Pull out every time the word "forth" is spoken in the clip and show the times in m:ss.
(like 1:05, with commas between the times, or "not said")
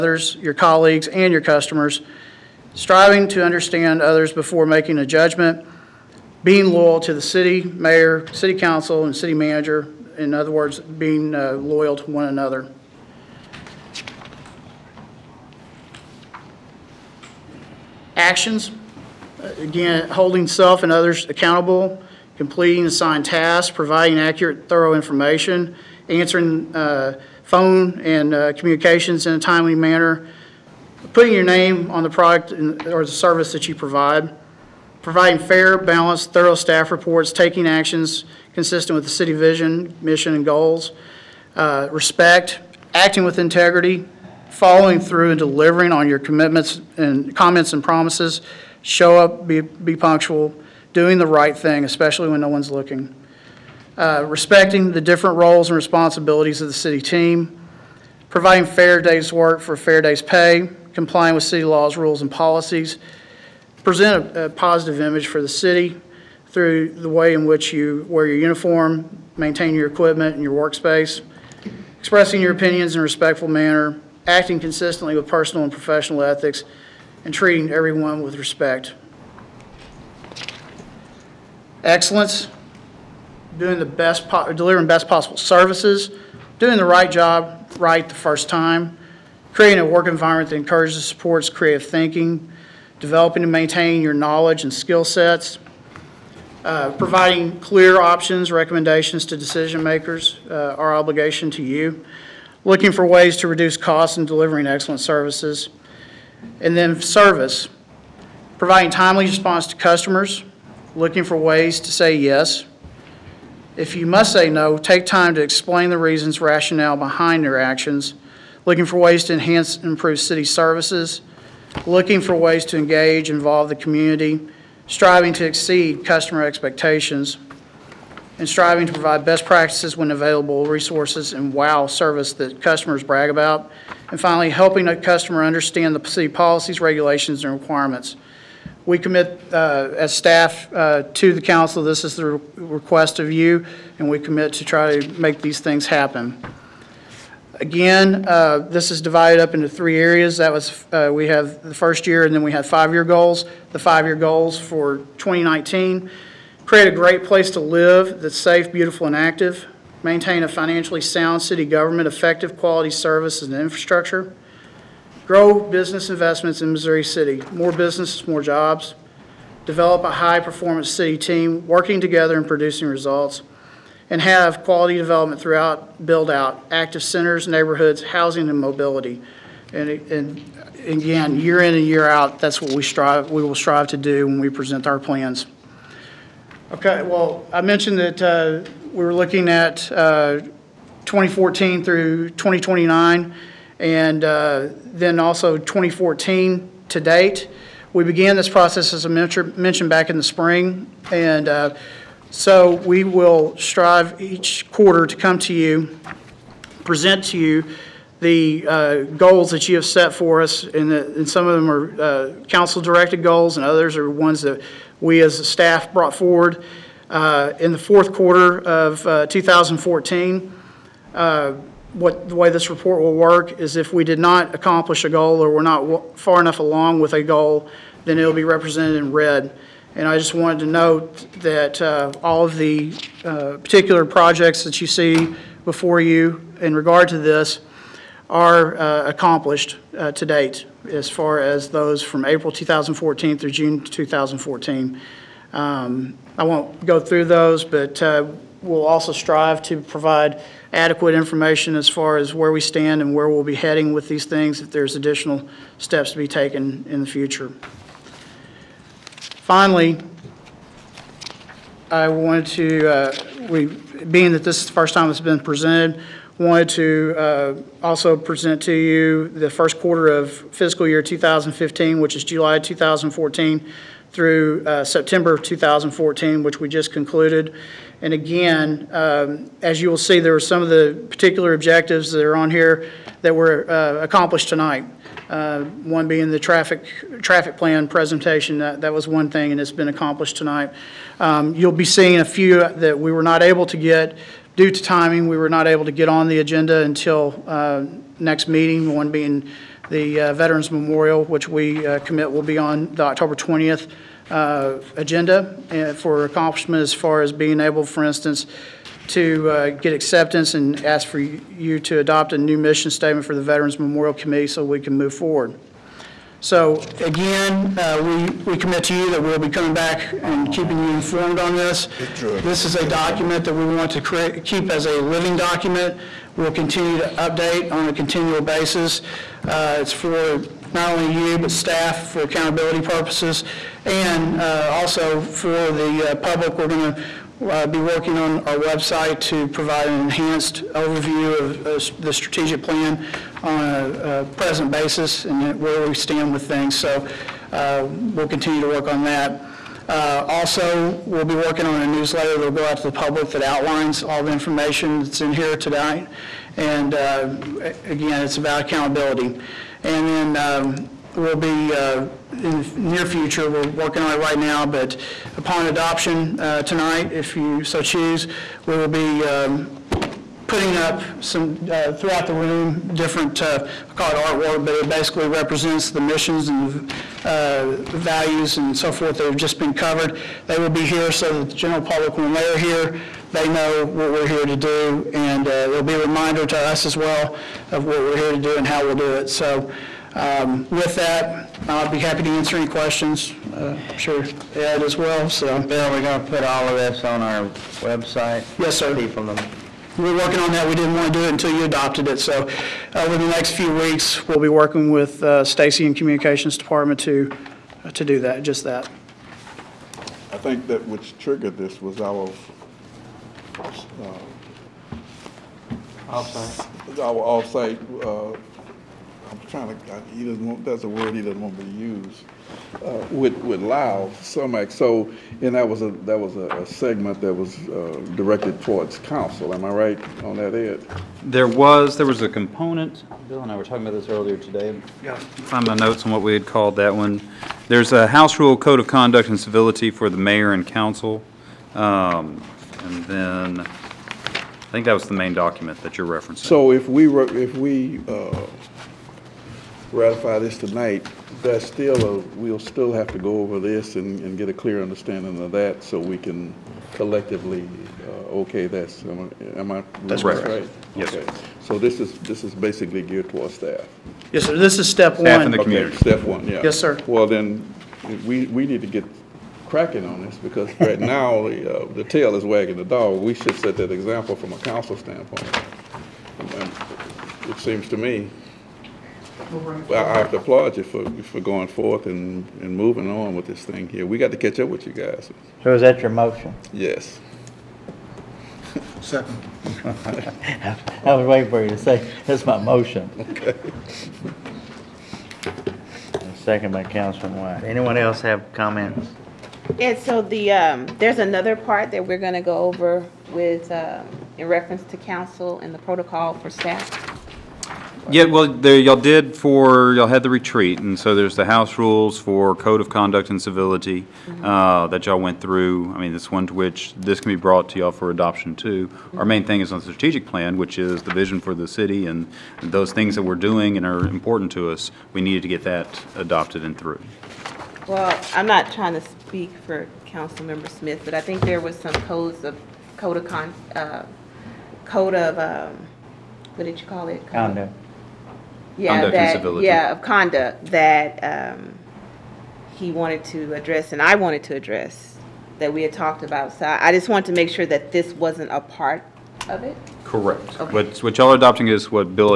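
6:18, 8:01.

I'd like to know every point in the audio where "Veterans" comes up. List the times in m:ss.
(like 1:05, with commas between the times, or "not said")
5:00, 5:13.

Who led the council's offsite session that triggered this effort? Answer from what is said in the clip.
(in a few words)
Lyle Sumek.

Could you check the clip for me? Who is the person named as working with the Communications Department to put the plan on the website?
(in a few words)
Stacy.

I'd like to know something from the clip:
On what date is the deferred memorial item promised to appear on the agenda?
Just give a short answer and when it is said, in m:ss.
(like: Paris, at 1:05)
October 20th, at 5:03.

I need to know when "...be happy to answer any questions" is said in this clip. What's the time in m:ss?
6:31.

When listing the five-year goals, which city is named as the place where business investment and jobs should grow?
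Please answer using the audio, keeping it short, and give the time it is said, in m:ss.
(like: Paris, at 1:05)
Missouri City, at 2:46.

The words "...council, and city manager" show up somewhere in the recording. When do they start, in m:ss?
0:08.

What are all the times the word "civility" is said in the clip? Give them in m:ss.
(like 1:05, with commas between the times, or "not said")
7:19, 8:33.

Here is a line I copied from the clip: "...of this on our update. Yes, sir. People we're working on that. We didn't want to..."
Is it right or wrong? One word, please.
wrong.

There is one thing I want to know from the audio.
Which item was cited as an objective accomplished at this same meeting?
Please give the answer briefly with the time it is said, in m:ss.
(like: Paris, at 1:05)
Traffic plan presentation, at 4:47.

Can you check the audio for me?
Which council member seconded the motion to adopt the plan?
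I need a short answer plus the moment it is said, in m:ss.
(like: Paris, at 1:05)
Councilman White, at 8:16.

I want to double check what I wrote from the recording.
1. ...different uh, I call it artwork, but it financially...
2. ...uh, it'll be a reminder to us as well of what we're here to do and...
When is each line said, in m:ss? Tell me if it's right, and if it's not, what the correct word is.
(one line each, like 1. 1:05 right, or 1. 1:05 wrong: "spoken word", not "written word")
1. 6:12 wrong: "basically", not "financially"
2. 6:25 right.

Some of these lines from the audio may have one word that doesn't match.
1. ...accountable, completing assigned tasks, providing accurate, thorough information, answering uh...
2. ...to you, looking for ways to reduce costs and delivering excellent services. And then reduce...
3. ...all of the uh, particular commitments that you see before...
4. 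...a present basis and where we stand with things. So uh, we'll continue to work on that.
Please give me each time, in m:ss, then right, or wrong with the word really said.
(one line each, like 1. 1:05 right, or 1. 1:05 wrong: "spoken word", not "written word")
1. 0:21 right
2. 1:41 wrong: "service", not "reduce"
3. 3:52 wrong: "projects", not "commitments"
4. 5:44 right.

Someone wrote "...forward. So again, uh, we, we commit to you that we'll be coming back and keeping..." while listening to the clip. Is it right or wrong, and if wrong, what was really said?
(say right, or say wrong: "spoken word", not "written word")
right.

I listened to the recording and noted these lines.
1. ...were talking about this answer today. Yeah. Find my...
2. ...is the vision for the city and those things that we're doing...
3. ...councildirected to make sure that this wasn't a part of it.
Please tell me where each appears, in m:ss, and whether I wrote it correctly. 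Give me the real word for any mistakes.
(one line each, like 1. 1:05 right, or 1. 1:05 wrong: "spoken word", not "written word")
1. 7:13 wrong: "earlier", not "answer"
2. 8:40 right
3. 9:07 wrong: "wanted", not "councildirected".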